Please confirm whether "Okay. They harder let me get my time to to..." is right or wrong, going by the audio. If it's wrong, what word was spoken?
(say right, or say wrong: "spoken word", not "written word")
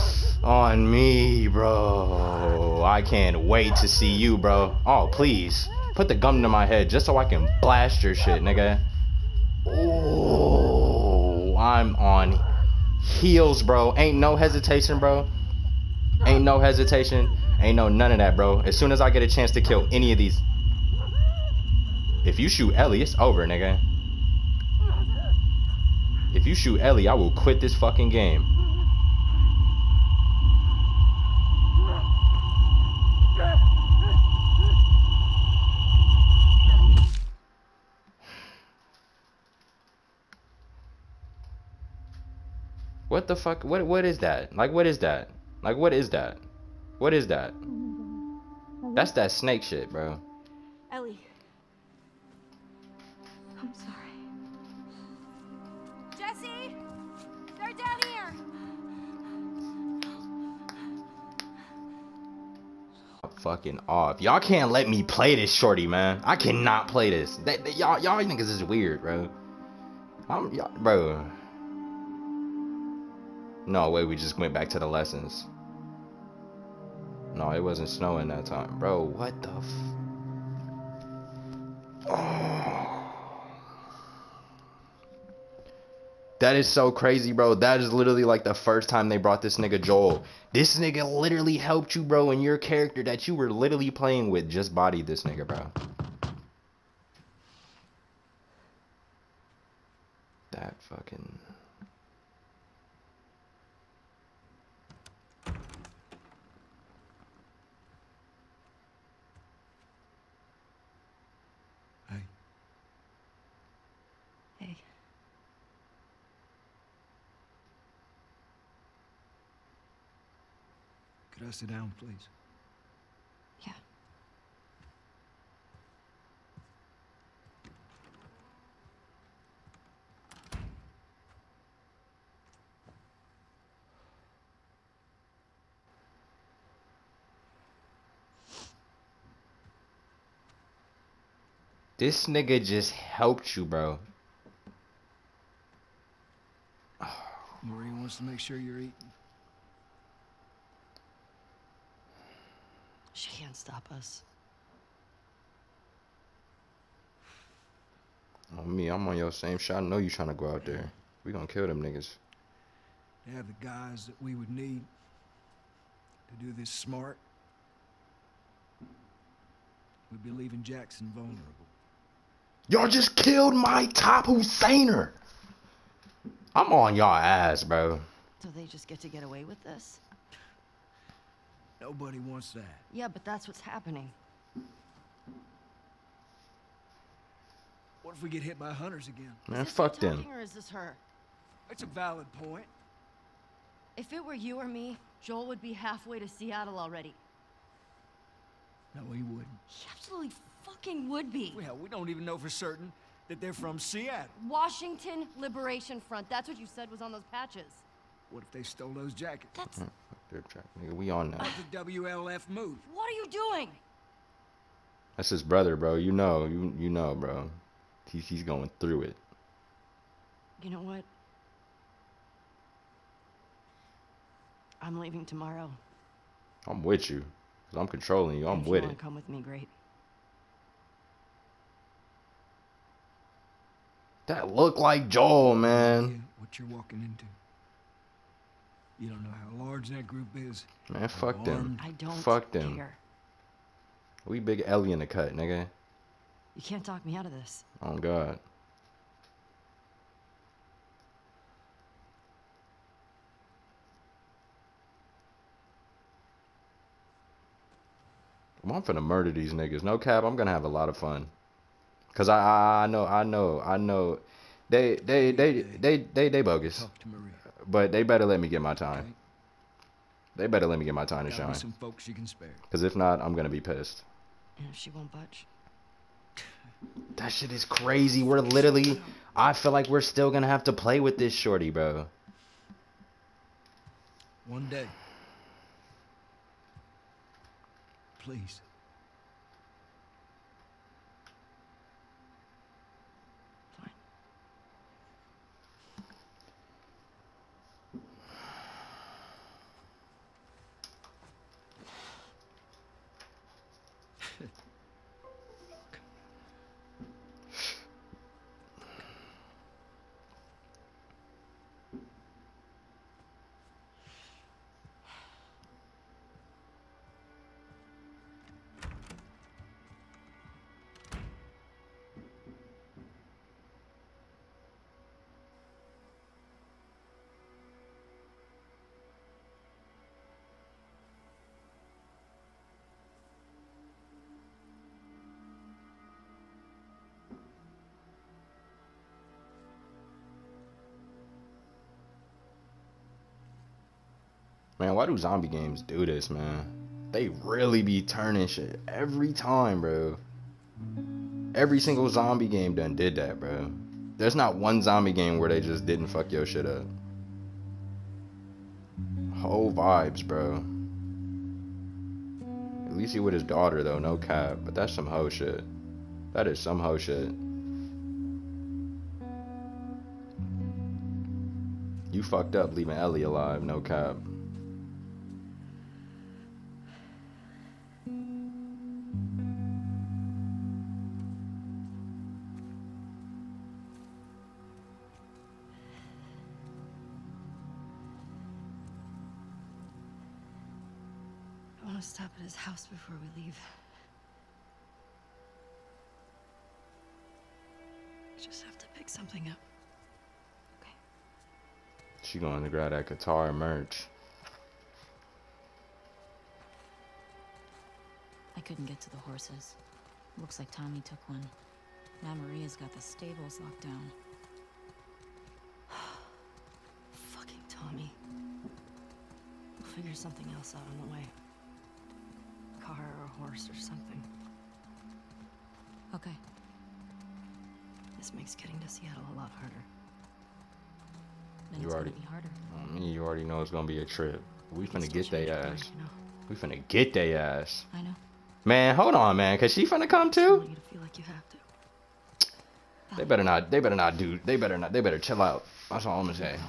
wrong: "better", not "harder".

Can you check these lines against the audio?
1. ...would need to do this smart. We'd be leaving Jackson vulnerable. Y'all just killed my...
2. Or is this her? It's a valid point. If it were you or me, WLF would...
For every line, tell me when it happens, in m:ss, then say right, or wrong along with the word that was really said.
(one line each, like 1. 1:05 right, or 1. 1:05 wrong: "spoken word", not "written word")
1. 2:44 right
2. 3:10 wrong: "Joel", not "WLF".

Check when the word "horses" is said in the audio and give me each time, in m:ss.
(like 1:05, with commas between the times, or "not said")
6:49, 7:03.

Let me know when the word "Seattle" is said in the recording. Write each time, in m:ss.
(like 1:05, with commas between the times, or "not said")
3:16, 3:23, 7:08.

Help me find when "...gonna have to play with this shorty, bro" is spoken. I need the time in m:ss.
4:40.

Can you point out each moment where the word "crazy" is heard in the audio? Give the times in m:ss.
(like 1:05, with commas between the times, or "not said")
1:26, 4:37.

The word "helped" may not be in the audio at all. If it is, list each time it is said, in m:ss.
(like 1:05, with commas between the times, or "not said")
1:31, 2:22.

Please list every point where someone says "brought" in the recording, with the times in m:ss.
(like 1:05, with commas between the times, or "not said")
1:29.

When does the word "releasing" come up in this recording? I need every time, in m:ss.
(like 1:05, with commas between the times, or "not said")
not said.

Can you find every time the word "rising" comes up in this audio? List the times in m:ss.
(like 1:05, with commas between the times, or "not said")
not said.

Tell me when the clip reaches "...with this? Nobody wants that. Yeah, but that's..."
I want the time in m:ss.
2:59.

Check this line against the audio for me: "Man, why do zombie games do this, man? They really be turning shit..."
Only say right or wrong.
right.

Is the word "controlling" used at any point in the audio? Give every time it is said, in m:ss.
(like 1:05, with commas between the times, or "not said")
3:47.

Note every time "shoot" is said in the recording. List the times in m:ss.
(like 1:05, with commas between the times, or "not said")
0:22, 0:26.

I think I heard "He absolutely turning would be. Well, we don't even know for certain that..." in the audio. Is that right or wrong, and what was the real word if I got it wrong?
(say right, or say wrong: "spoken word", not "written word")
wrong: "fucking", not "turning".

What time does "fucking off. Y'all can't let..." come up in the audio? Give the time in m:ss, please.
1:03.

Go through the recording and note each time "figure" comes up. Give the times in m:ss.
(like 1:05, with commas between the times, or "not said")
6:59.